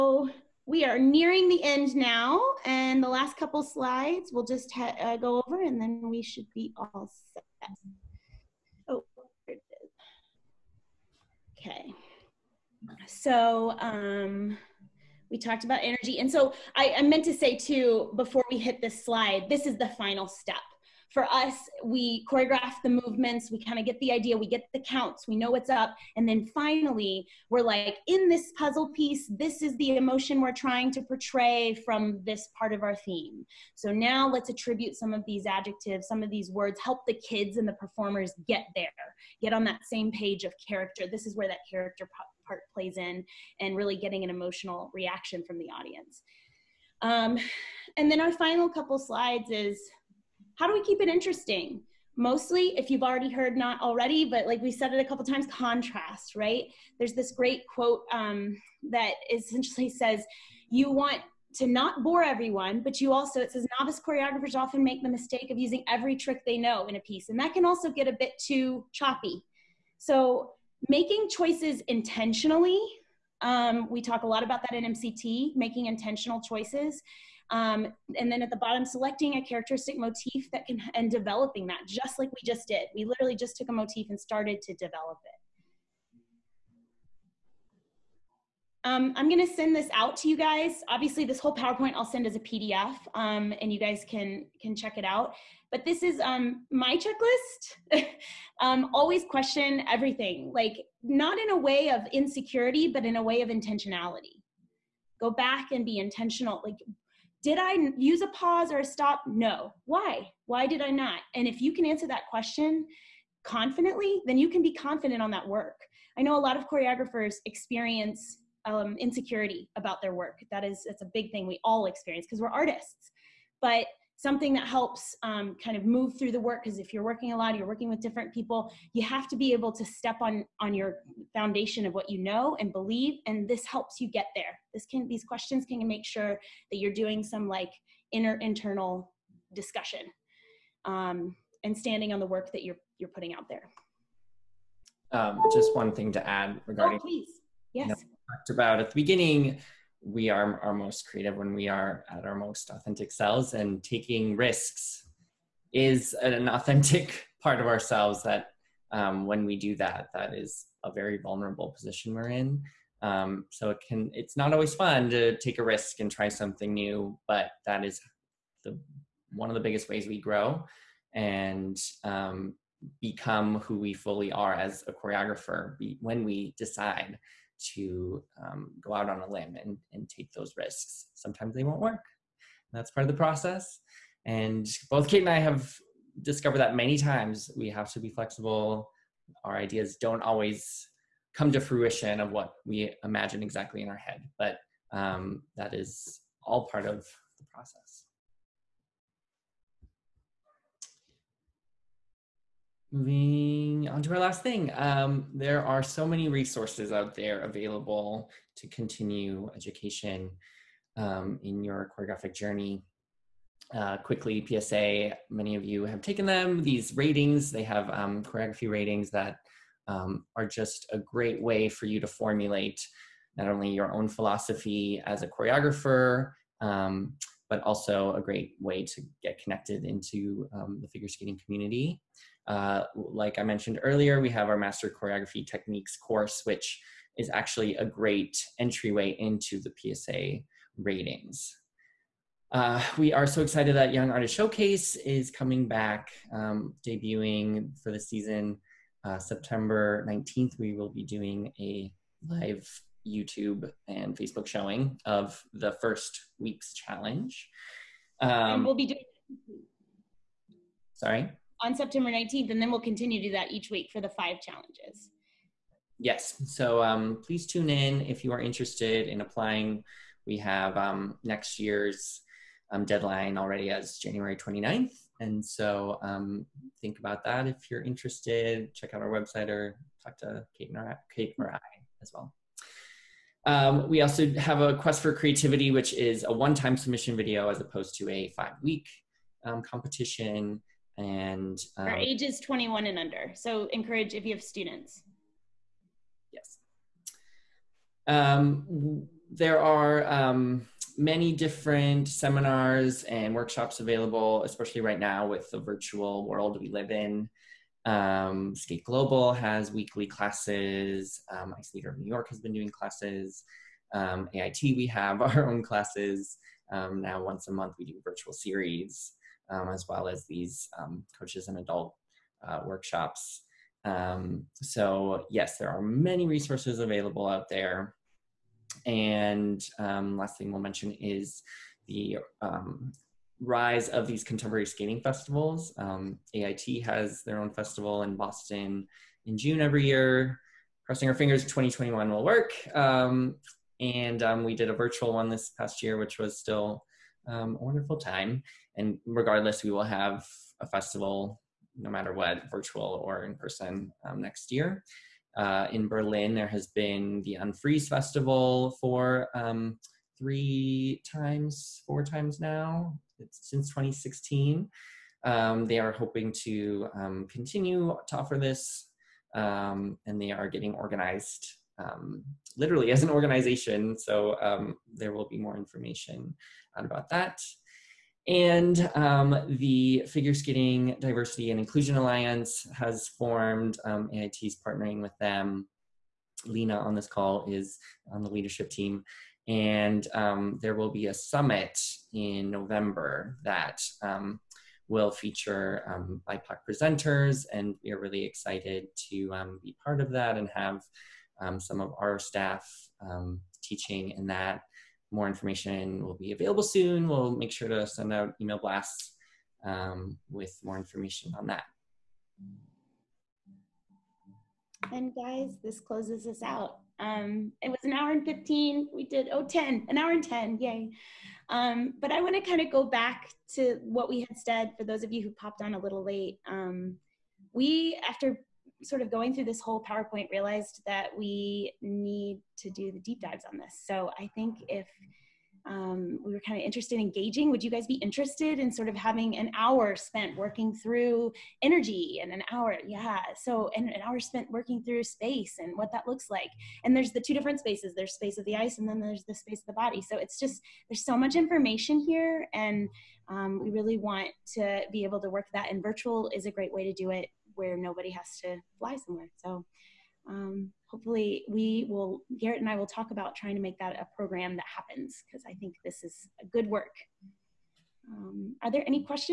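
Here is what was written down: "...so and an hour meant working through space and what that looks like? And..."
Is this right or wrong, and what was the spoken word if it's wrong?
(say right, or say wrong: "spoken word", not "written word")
wrong: "spent", not "meant".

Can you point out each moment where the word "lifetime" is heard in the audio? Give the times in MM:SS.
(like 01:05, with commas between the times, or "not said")
not said.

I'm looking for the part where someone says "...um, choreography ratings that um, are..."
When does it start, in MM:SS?
03:37.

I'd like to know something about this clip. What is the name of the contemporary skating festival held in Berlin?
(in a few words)
Unfreeze Festival.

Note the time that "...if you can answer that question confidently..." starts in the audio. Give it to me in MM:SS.
01:51.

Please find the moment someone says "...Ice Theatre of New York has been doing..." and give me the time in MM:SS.
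05:11.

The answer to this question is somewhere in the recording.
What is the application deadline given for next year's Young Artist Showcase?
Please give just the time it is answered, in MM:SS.
04:33.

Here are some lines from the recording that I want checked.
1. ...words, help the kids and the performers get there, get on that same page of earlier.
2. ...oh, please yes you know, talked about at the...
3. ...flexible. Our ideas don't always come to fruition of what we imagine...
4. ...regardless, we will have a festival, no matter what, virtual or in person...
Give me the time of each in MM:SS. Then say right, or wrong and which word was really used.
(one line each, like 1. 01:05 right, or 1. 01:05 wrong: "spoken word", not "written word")
1. 00:36 wrong: "character", not "earlier"
2. 02:26 right
3. 03:08 right
4. 05:49 right.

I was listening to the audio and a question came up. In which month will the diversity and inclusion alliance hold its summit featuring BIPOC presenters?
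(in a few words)
November.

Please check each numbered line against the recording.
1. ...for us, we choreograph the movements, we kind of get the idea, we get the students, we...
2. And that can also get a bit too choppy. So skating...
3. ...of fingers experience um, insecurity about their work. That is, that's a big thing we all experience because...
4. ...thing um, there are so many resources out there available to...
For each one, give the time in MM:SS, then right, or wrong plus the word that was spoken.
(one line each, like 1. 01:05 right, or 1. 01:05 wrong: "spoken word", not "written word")
1. 00:21 wrong: "counts", not "students"
2. 01:07 wrong: "making", not "skating"
3. 01:56 wrong: "choreographers", not "fingers"
4. 03:24 right.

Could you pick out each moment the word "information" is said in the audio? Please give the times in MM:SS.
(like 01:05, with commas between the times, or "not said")
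06:15, 06:45, 06:50, 07:31.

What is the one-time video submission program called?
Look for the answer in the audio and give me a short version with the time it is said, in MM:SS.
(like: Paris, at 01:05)
Quest for Creativity, at 04:44.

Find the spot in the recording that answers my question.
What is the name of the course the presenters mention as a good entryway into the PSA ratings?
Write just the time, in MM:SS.
03:54.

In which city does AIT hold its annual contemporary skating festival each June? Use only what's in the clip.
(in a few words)
Boston.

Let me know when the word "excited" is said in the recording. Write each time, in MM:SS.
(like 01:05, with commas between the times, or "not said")
04:03, 06:38.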